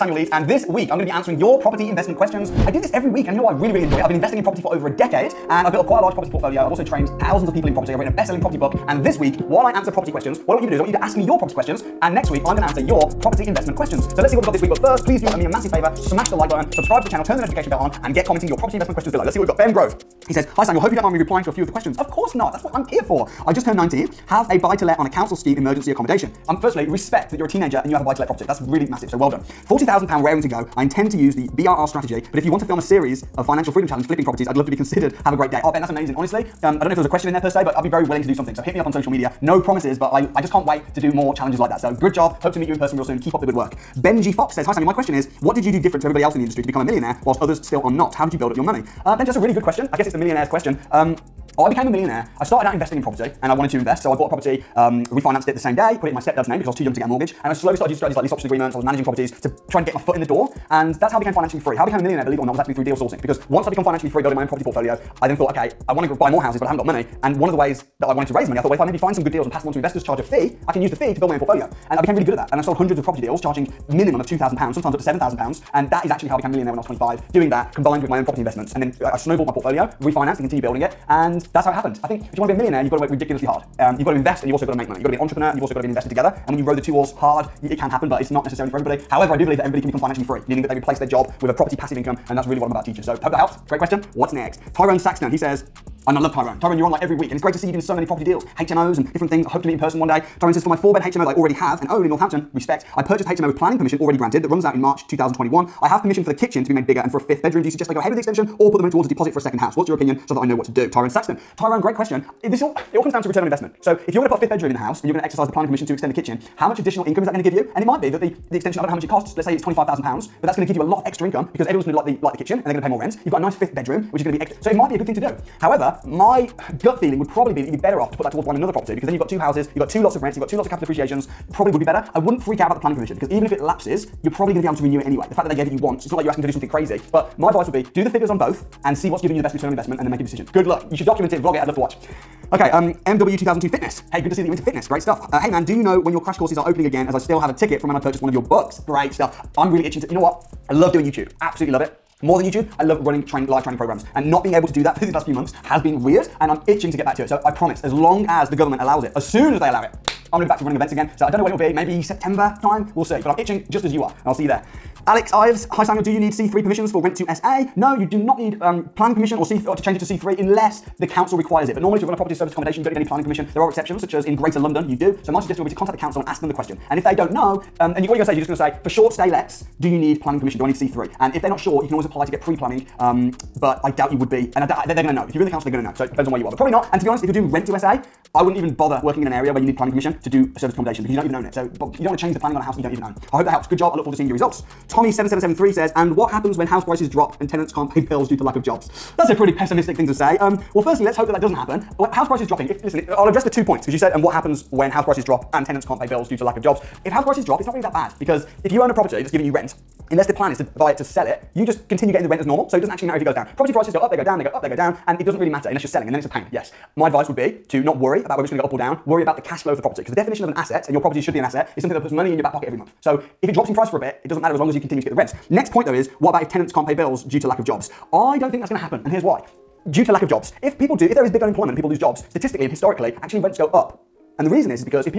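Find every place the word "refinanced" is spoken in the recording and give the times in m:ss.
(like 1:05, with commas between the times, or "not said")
0:55, 1:20.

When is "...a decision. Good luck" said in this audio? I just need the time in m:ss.
2:20.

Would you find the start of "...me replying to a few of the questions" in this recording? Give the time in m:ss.
0:21.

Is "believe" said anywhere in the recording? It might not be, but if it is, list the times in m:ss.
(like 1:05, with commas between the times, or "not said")
1:02, 1:29.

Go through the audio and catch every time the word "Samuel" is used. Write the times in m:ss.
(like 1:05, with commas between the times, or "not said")
0:20, 0:44, 2:45.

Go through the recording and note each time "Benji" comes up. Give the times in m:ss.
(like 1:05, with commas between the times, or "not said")
0:43, 0:49.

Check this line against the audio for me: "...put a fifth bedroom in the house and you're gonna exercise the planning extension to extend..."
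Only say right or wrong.
wrong.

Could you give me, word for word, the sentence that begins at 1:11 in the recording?
And I became really good at that.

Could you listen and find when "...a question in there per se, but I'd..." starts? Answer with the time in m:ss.
0:37.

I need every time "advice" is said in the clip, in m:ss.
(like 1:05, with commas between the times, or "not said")
2:17, 3:37.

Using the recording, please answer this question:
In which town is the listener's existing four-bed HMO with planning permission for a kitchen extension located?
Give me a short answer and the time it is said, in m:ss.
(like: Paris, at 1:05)
Northampton, at 1:42.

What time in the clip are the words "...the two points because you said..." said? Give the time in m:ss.
3:23.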